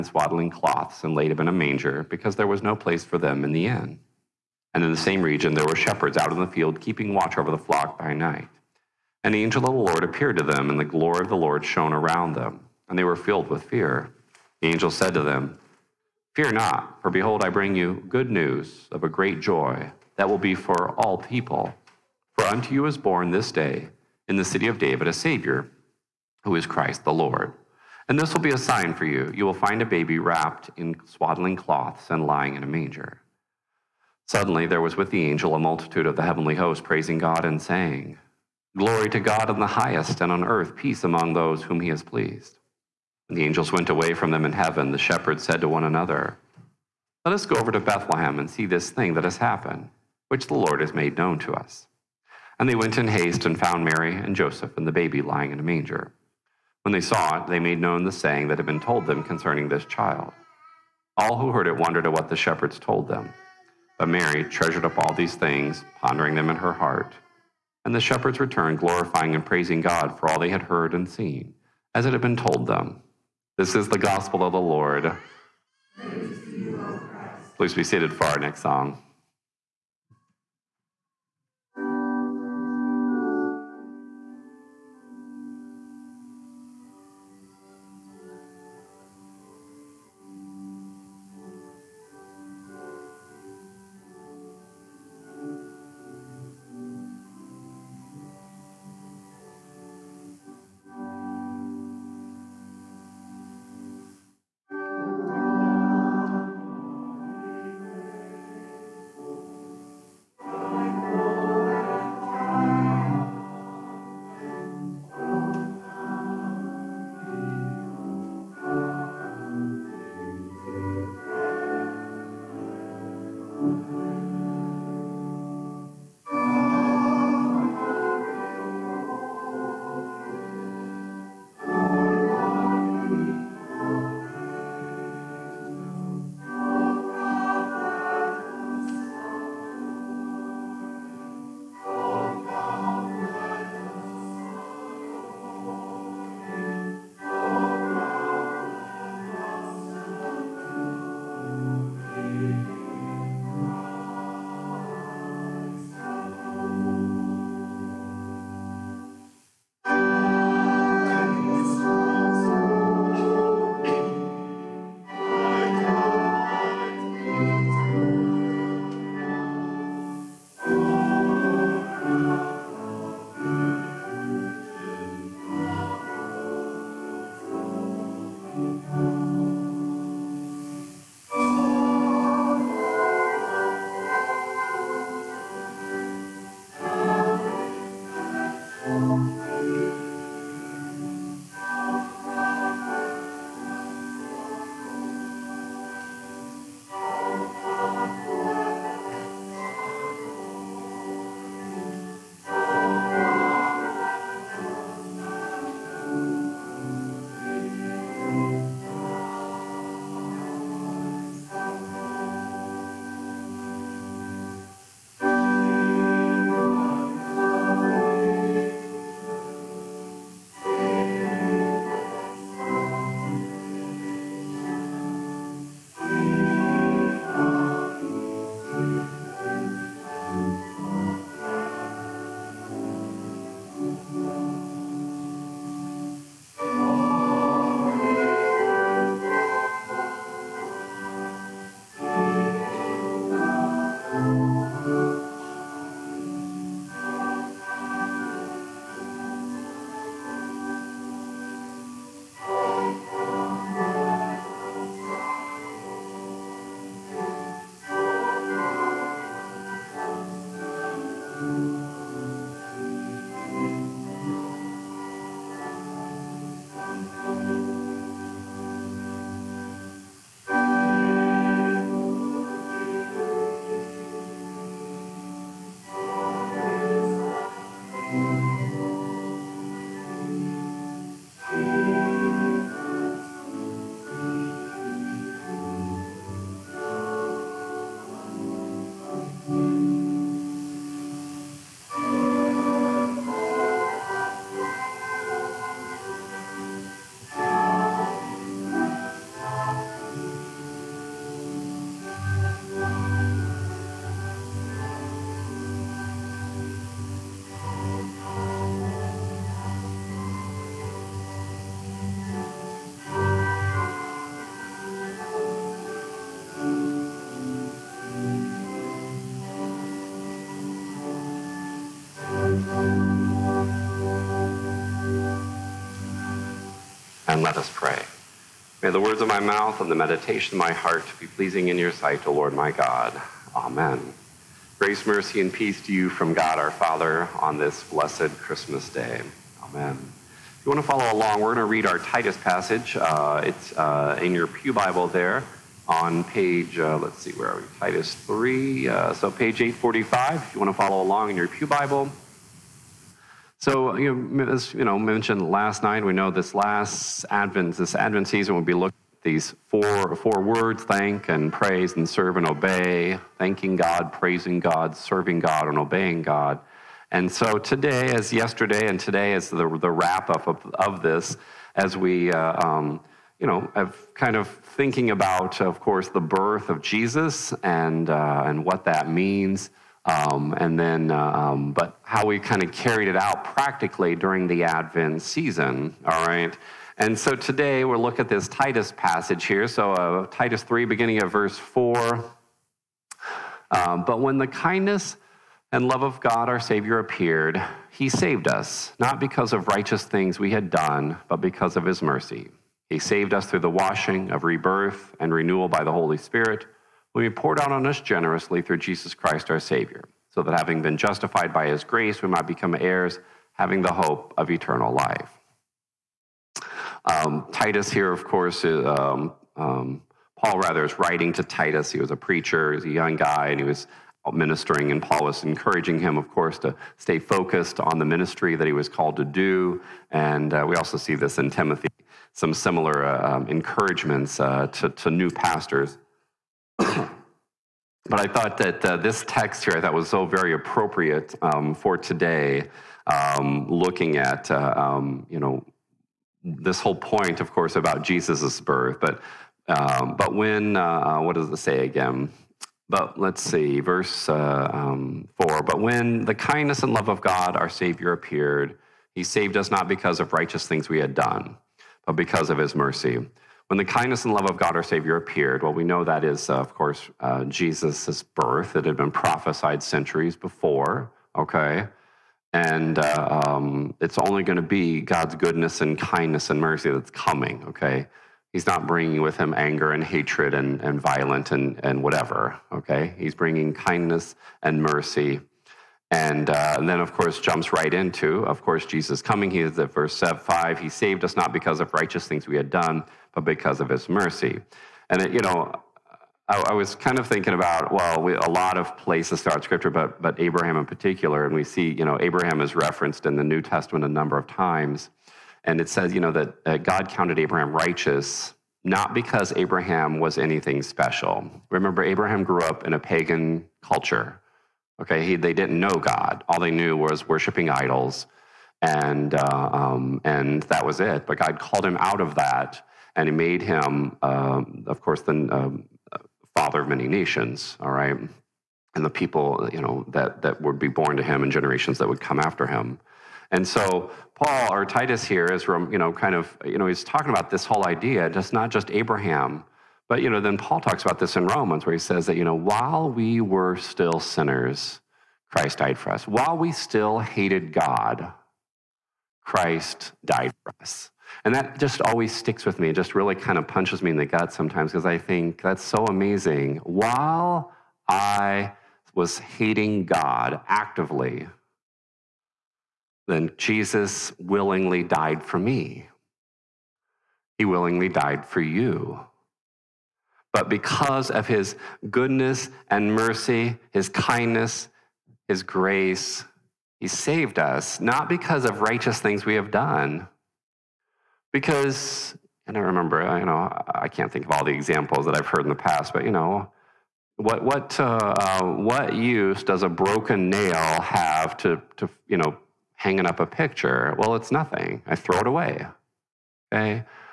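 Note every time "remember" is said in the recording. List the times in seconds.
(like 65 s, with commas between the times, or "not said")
511 s, 582 s.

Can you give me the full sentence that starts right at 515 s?
Okay, he, they didn't know God.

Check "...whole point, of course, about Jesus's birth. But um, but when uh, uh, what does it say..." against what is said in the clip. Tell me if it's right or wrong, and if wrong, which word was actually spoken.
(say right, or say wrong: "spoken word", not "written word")
right.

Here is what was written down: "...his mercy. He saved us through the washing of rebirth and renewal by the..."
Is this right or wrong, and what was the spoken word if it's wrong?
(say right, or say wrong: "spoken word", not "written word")
right.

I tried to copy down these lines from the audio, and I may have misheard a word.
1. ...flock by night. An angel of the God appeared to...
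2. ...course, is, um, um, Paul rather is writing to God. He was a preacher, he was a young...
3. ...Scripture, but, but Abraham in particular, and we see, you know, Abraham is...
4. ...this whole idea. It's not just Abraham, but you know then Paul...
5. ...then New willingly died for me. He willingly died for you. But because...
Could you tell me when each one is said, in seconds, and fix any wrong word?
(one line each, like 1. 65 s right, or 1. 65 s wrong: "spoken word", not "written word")
1. 7 s wrong: "Lord", not "God"
2. 418 s wrong: "Titus", not "God"
3. 499 s right
4. 537 s right
5. 563 s wrong: "Jesus", not "New".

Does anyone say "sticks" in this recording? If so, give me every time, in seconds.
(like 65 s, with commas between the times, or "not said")
552 s.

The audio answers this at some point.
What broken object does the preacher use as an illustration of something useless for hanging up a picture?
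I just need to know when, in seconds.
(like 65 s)
589 s.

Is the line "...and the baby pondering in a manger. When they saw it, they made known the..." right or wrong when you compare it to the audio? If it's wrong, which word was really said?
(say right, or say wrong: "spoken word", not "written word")
wrong: "lying", not "pondering".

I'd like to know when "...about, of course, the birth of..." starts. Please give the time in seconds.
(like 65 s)
375 s.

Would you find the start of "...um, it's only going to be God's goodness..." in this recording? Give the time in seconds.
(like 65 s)
473 s.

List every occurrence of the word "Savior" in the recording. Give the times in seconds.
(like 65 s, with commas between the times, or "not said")
25 s, 396 s, 409 s, 457 s, 464 s.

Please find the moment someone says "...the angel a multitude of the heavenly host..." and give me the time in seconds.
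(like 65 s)
35 s.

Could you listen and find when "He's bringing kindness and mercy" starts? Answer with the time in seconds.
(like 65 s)
483 s.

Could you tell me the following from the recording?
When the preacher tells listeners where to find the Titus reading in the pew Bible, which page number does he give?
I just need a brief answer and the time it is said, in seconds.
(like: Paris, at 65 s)
845, at 349 s.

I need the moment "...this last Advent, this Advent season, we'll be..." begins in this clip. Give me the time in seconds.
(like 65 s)
356 s.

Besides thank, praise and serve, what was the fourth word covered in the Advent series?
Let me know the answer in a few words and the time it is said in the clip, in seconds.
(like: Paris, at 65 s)
obey, at 362 s.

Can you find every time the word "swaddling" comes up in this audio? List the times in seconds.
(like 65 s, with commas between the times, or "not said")
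0 s, 31 s.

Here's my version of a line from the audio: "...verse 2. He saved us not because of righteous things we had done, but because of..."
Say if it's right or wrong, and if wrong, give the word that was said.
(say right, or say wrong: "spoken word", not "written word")
wrong: "5", not "2".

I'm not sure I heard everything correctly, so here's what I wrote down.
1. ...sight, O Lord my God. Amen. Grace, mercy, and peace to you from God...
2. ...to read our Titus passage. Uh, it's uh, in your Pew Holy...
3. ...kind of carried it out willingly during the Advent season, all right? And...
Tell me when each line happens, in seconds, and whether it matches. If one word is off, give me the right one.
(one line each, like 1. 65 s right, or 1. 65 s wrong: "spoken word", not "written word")
1. 331 s right
2. 341 s wrong: "Bible", not "Holy"
3. 382 s wrong: "practically", not "willingly".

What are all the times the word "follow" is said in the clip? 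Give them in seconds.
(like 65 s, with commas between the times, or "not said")
340 s, 350 s.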